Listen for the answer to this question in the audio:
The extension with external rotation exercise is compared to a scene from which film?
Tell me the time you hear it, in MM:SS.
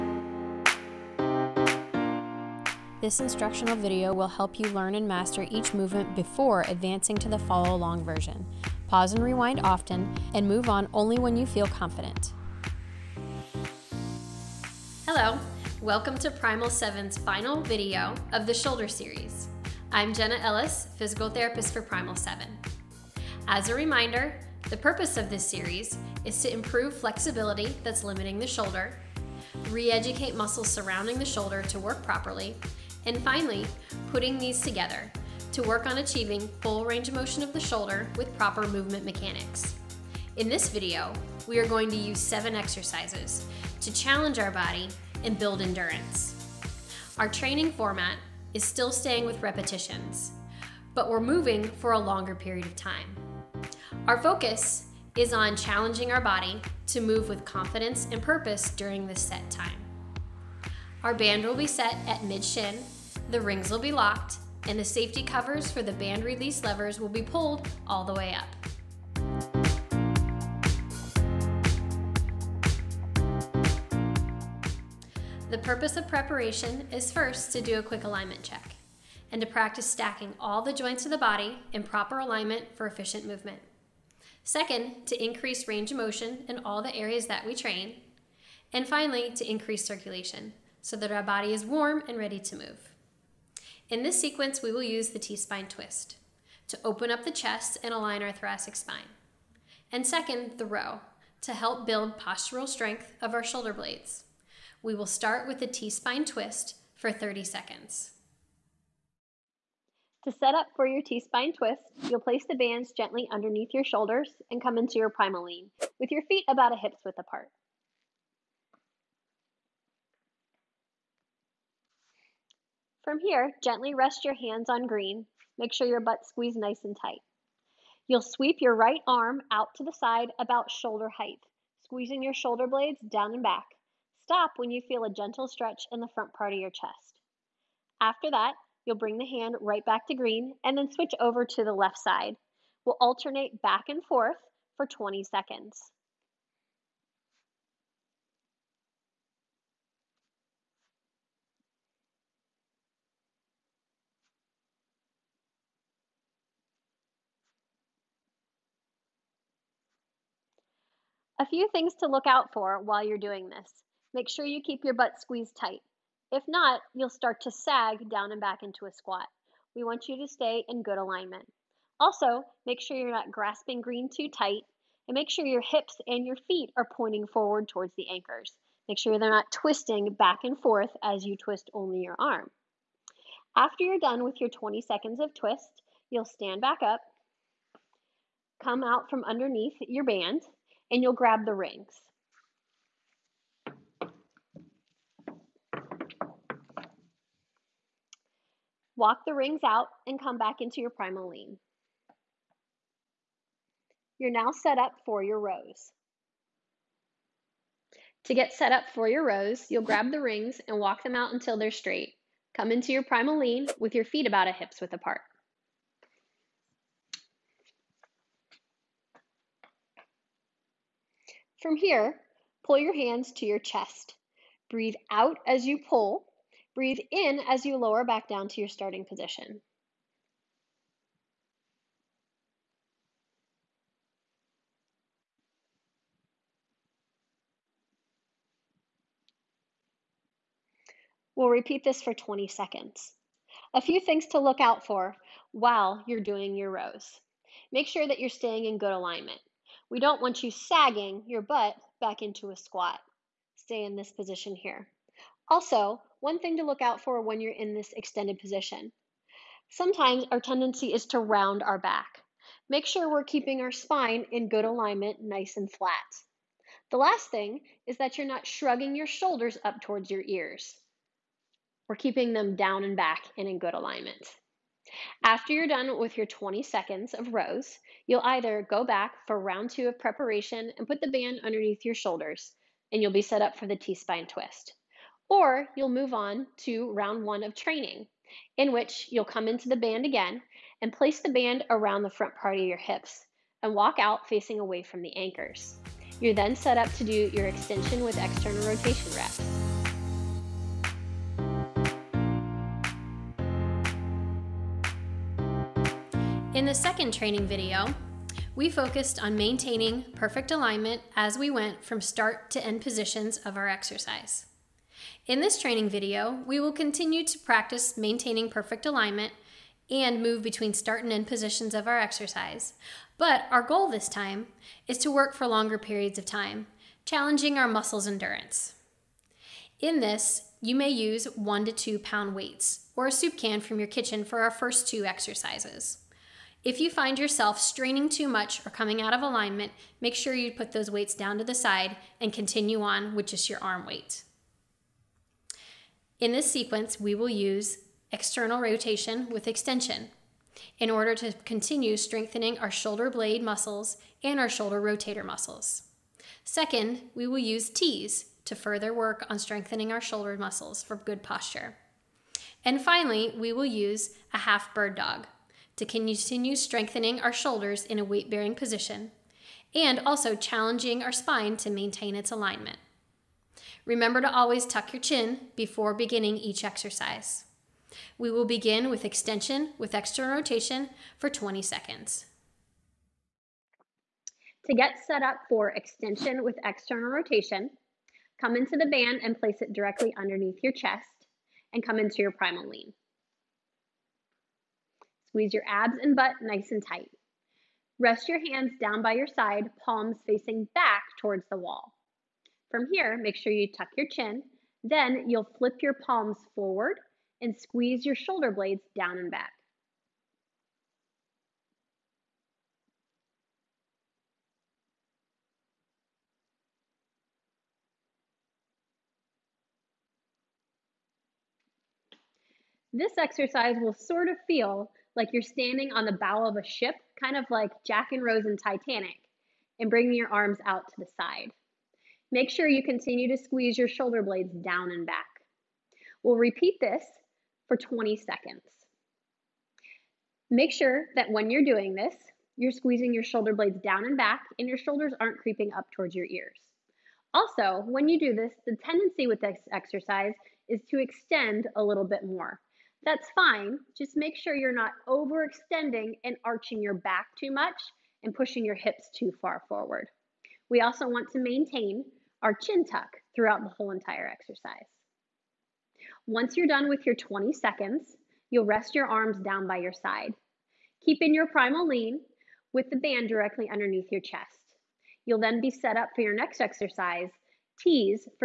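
07:08.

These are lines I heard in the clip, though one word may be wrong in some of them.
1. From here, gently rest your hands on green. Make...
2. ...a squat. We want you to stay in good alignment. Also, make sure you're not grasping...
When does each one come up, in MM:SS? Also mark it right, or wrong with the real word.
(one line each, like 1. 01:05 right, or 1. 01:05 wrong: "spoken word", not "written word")
1. 02:03 right
2. 02:48 right.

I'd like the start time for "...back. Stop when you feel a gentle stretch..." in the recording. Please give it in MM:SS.
02:13.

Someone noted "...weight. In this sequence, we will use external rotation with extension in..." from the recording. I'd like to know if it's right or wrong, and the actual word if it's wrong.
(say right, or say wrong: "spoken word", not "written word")
right.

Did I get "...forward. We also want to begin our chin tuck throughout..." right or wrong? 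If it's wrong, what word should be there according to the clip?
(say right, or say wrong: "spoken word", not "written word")
wrong: "maintain", not "begin".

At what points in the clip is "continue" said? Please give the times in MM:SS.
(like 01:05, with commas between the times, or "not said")
05:16, 05:42, 05:51, 06:05, 07:12.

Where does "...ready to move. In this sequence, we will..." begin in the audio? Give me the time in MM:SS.
01:32.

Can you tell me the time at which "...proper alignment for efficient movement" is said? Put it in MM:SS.
01:21.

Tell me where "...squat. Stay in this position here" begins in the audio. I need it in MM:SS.
04:12.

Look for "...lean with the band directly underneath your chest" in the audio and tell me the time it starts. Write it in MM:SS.
07:51.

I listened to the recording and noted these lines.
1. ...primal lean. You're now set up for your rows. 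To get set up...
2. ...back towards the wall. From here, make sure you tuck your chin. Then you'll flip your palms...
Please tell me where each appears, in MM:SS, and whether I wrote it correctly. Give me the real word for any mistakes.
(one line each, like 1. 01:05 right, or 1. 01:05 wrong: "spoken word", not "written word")
1. 03:20 right
2. 06:40 right.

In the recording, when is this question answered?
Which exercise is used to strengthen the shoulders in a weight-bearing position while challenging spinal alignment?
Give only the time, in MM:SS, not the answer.
06:04.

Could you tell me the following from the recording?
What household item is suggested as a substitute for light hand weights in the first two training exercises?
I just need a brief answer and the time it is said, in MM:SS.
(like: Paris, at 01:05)
a soup can, at 05:33.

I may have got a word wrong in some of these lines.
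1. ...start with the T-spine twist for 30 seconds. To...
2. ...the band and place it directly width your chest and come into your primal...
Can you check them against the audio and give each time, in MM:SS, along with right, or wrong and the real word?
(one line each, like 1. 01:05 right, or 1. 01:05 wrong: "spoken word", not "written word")
1. 01:45 right
2. 06:28 wrong: "underneath", not "width".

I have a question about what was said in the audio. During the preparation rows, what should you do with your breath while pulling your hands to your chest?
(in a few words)
Breathe out.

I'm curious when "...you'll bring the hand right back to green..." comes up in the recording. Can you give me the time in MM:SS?
02:18.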